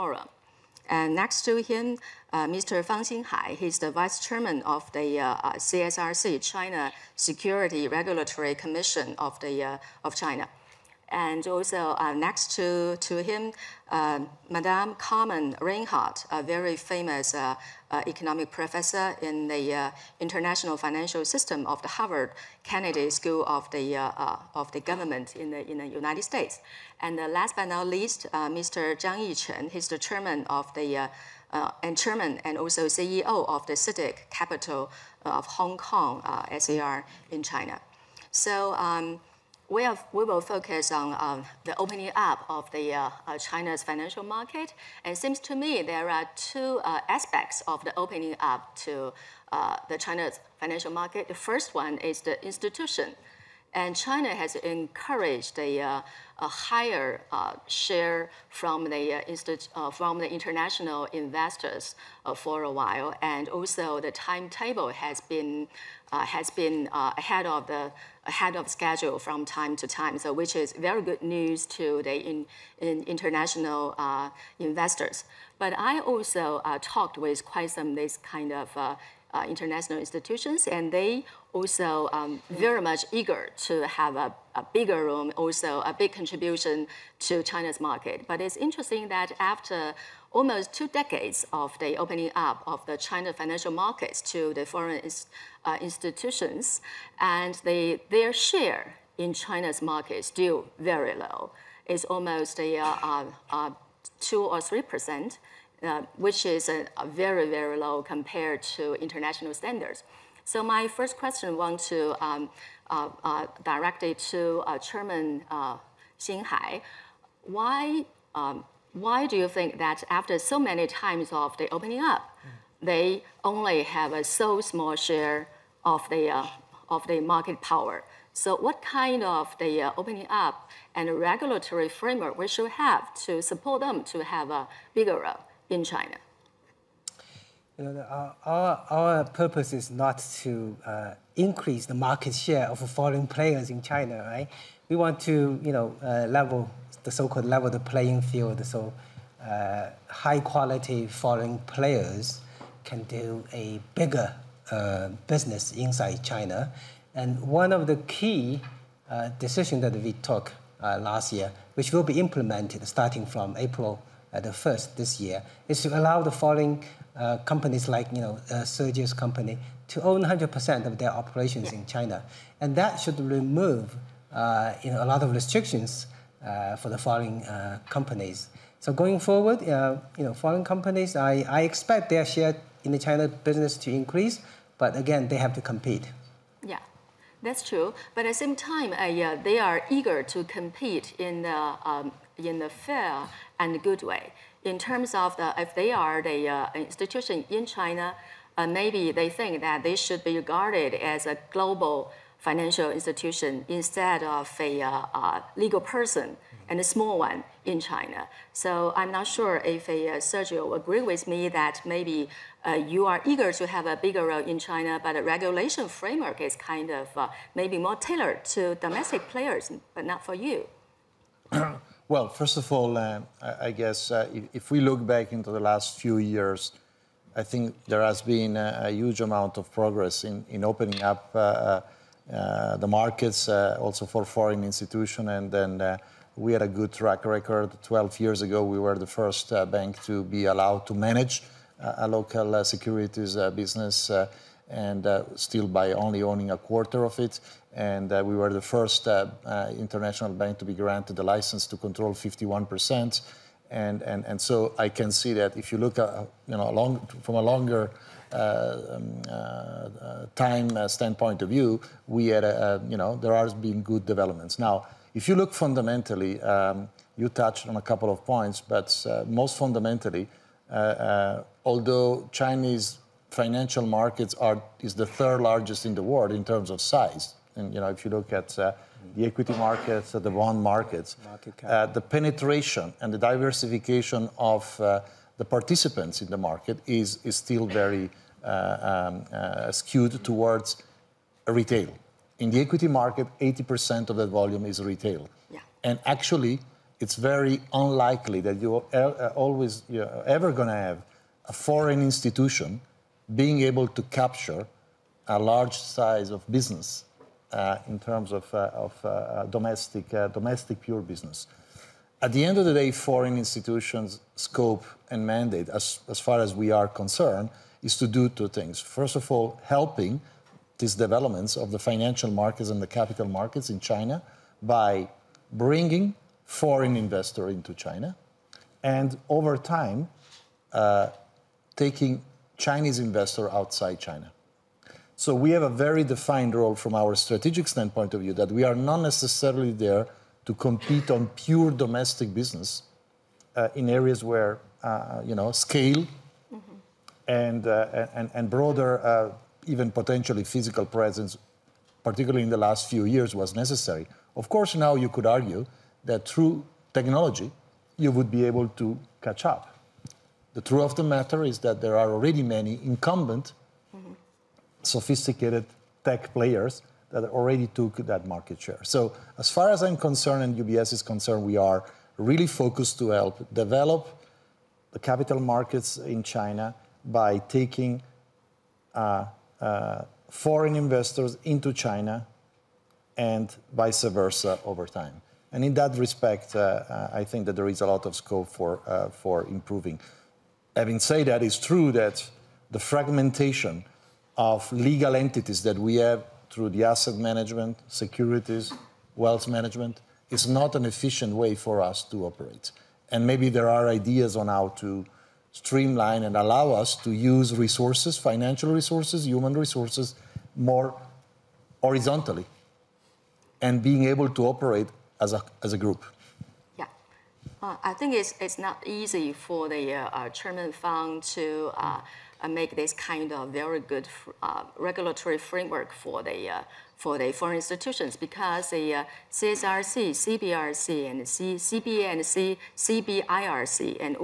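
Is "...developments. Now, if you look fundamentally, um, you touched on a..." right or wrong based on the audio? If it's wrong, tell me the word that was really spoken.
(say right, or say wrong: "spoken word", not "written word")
right.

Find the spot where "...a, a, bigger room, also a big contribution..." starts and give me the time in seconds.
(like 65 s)
84 s.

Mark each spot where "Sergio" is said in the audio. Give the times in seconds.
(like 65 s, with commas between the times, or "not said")
168 s, 210 s.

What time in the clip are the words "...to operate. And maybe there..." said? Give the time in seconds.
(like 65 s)
402 s.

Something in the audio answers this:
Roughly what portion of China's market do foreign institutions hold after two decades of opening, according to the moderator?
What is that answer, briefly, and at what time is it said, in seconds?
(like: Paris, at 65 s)
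2 or 3 percent, at 104 s.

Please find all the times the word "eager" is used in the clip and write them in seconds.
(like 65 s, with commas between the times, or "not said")
83 s, 189 s, 213 s.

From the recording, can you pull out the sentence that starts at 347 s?
and, uh, and and broader uh, even potentially physical presence, particularly in the last few years, was necessary.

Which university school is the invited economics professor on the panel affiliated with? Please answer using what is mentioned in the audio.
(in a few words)
Harvard Kennedy School.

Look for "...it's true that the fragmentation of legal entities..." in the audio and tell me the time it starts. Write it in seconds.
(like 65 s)
391 s.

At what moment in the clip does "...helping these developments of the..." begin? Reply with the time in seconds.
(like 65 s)
319 s.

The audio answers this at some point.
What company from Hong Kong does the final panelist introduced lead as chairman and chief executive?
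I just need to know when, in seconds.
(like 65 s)
33 s.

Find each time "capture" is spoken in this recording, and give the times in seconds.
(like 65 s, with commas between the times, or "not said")
304 s.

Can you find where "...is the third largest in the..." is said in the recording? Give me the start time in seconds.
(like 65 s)
274 s.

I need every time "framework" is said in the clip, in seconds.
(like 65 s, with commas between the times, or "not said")
131 s, 215 s, 425 s.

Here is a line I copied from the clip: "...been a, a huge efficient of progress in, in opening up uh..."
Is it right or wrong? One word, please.
wrong.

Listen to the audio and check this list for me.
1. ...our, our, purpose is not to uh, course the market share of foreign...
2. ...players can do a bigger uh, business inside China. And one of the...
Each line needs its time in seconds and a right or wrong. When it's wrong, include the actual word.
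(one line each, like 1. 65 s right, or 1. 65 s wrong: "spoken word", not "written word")
1. 138 s wrong: "increase", not "course"
2. 151 s right.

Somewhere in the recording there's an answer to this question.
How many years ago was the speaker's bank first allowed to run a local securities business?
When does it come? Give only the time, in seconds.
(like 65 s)
237 s.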